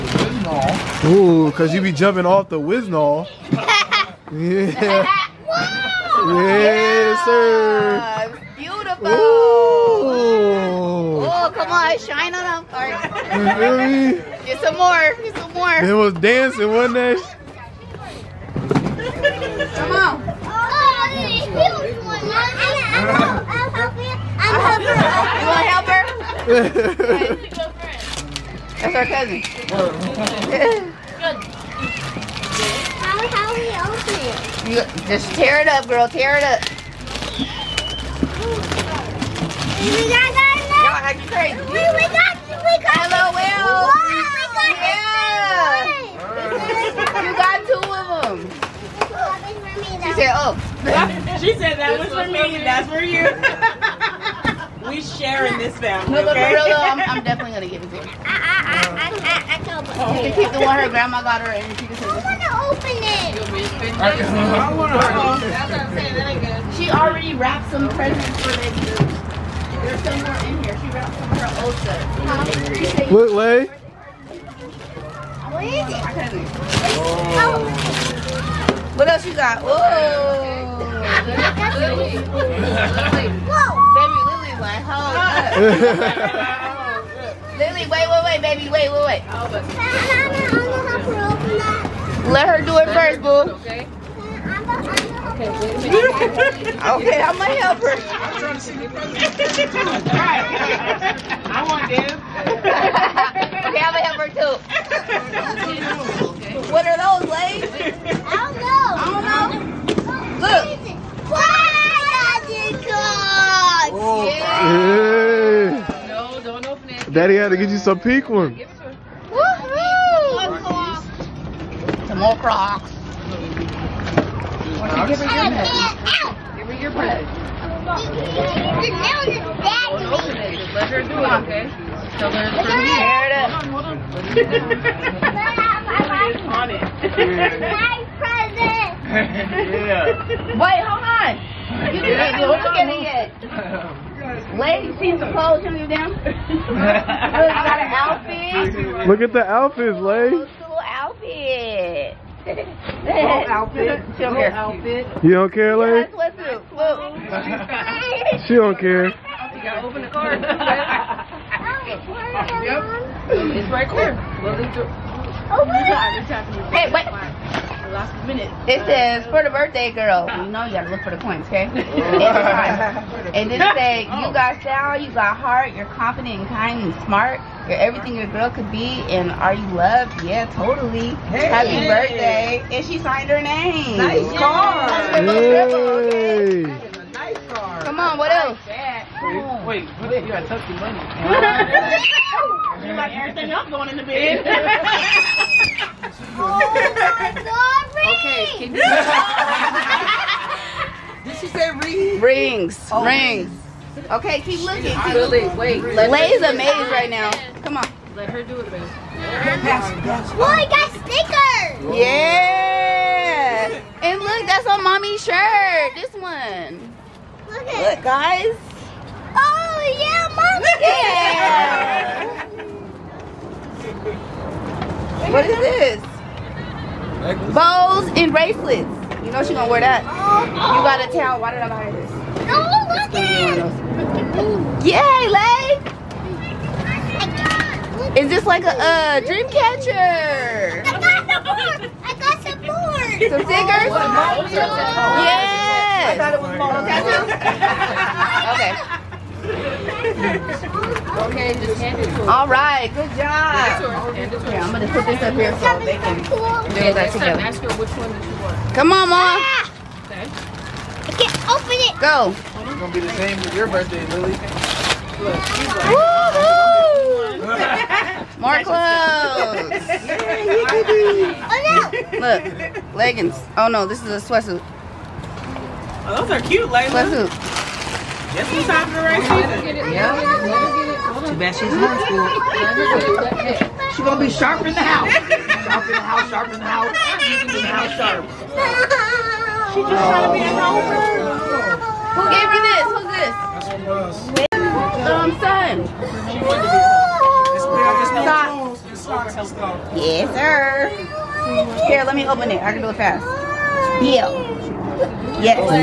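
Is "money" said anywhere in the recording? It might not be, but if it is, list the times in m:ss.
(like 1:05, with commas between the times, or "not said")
3:10.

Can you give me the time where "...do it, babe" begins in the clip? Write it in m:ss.
3:28.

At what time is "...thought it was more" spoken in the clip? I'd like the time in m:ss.
4:06.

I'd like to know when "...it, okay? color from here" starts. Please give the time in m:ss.
2:11.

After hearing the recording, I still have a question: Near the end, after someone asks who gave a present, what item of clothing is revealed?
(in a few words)
Socks.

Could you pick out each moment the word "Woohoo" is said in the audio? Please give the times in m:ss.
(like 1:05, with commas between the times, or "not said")
1:59, 4:25.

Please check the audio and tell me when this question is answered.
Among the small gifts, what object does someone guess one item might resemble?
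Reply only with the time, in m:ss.
3:59.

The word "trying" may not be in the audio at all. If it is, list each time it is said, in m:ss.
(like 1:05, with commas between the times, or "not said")
1:38, 4:50.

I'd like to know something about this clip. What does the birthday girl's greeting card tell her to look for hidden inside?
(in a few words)
the coins.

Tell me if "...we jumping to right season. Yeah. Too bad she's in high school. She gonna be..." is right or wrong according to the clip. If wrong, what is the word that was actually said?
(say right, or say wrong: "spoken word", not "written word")
wrong: "talking", not "jumping".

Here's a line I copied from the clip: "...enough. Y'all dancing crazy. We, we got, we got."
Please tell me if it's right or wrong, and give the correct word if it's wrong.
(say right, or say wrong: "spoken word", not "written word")
wrong: "acting", not "dancing".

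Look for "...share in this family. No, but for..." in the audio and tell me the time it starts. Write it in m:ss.
0:55.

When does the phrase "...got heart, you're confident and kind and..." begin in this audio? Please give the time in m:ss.
2:55.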